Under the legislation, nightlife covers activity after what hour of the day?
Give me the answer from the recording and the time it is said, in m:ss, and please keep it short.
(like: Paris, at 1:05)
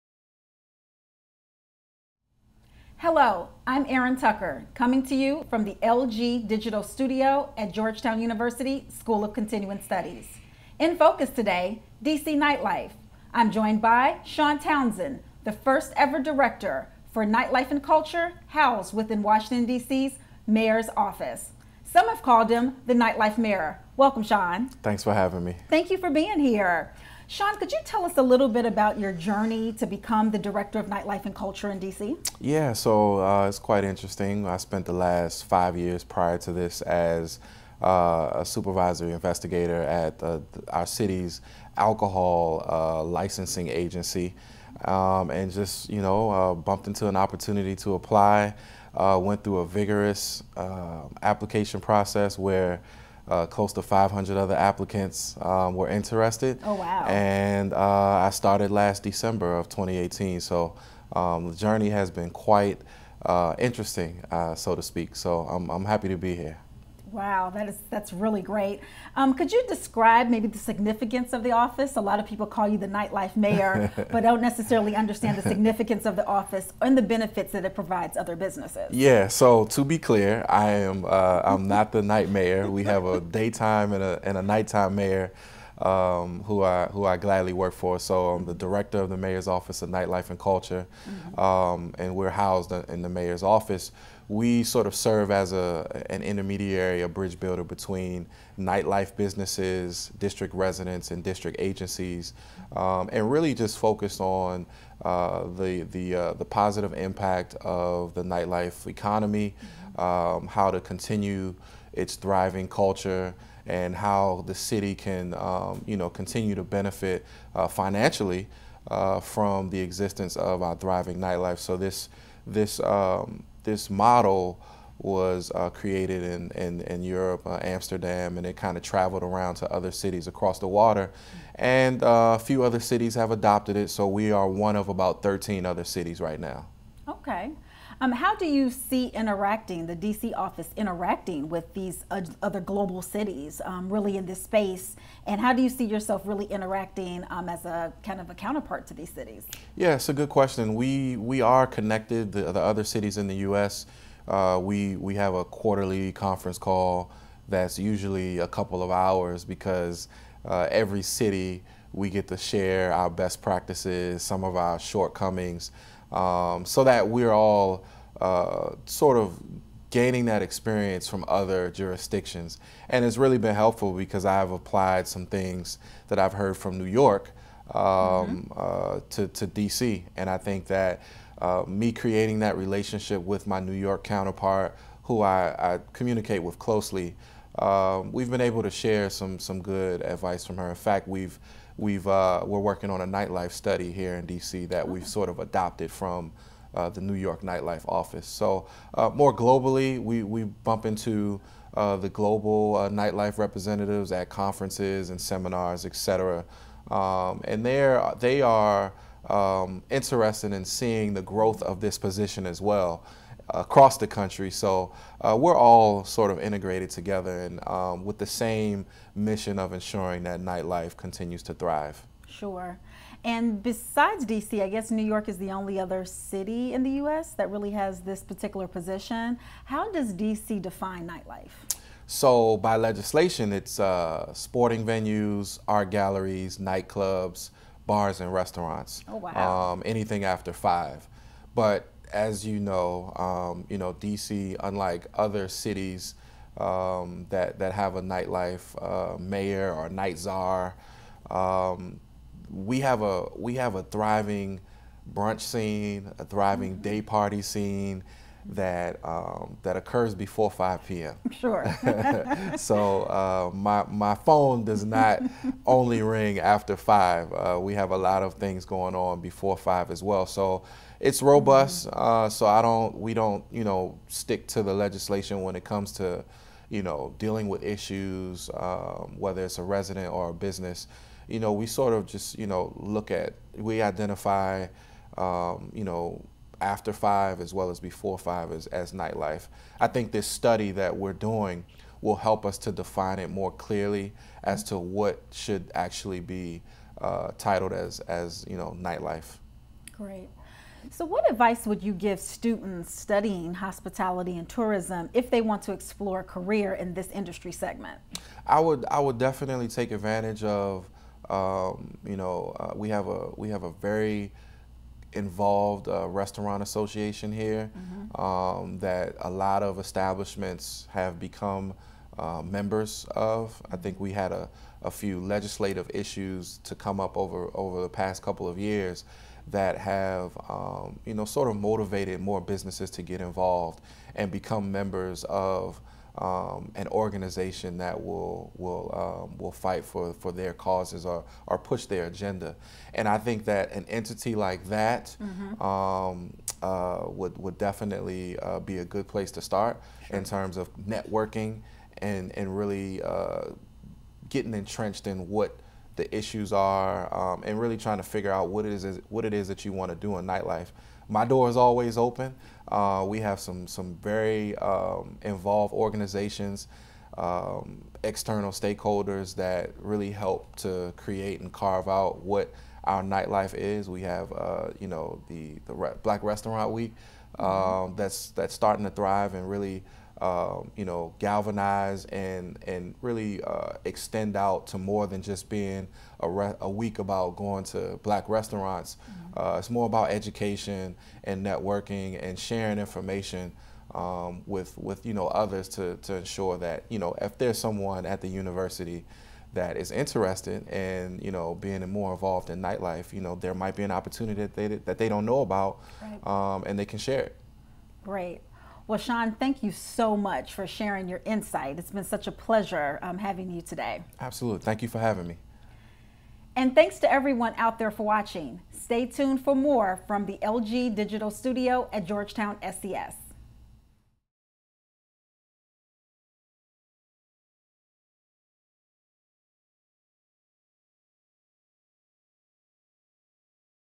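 5, at 3:59.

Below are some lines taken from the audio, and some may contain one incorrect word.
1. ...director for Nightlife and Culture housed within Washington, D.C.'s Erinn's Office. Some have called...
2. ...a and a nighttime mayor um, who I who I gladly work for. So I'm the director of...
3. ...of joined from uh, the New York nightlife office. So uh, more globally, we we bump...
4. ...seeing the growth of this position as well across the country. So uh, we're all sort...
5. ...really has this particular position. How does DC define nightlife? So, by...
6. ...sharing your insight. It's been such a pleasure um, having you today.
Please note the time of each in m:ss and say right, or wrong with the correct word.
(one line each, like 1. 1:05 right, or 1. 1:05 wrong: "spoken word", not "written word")
1. 0:16 wrong: "Mayor", not "Erinn"
2. 1:24 right
3. 3:15 wrong: "adopted", not "joined"
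4. 3:30 right
5. 3:47 right
6. 6:50 right.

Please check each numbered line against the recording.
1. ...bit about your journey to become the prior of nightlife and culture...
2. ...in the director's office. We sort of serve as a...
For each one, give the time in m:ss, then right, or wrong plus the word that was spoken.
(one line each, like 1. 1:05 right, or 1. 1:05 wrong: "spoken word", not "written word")
1. 0:28 wrong: "director", not "prior"
2. 1:32 wrong: "mayor", not "director".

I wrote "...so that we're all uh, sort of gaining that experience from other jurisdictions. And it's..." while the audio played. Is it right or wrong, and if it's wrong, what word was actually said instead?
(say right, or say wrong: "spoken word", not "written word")
right.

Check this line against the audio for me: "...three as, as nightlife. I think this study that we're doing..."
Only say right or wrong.
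wrong.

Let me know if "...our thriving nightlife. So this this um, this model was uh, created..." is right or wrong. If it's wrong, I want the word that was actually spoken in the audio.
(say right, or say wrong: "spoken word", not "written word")
right.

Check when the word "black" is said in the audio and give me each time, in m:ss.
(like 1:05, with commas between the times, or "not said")
6:16, 6:28.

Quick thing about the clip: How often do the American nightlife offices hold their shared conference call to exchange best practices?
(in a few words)
Quarterly.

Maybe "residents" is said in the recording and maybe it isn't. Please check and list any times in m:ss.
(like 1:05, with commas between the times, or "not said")
1:40, 4:39.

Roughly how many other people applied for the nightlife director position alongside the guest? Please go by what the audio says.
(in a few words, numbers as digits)
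500.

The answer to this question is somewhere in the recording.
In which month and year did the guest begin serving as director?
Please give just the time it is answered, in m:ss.
0:59.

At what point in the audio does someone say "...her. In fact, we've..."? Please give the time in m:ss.
3:10.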